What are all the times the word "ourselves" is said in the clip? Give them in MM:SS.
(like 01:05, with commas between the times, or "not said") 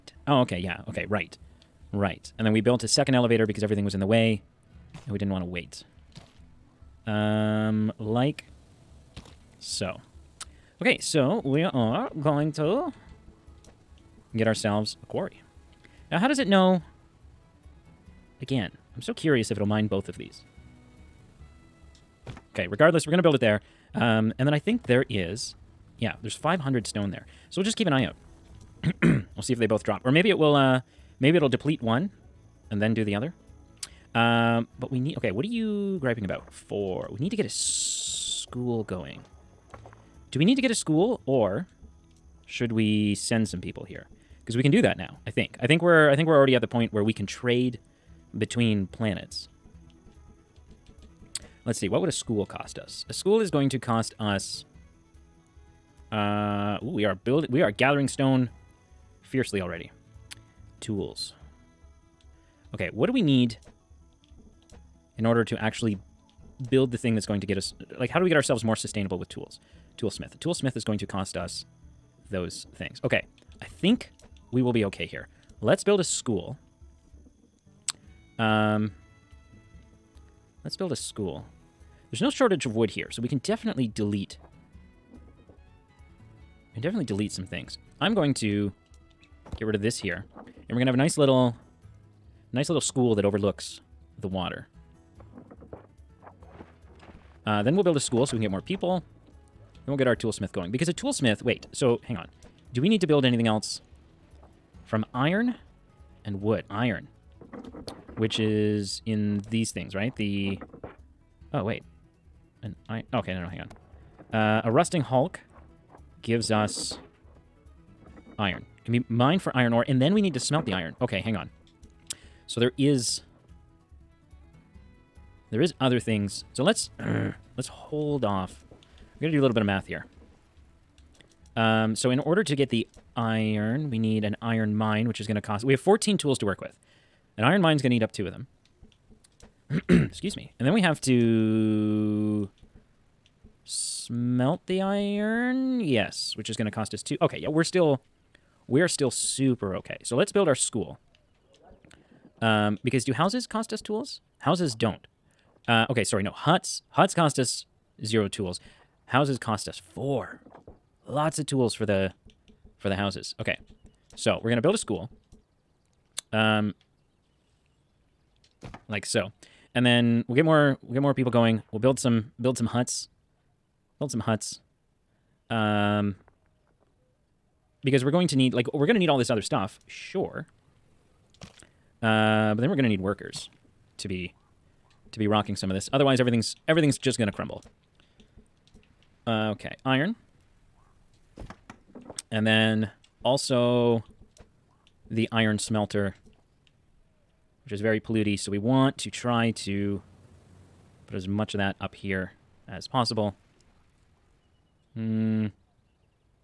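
00:14, 01:08.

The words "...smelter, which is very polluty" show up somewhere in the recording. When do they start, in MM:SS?
03:15.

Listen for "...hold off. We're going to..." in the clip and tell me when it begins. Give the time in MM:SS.
02:07.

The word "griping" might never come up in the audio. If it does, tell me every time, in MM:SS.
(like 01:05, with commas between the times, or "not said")
00:36.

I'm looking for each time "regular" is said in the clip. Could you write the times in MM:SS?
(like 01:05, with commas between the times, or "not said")
not said.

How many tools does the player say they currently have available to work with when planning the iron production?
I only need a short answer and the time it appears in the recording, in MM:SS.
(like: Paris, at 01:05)
14, at 02:15.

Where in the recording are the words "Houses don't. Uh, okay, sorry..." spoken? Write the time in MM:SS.
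02:34.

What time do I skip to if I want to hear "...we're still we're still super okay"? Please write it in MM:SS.
02:27.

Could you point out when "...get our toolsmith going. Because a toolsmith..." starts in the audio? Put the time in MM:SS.
01:39.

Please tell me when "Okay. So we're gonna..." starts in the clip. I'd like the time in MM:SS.
02:43.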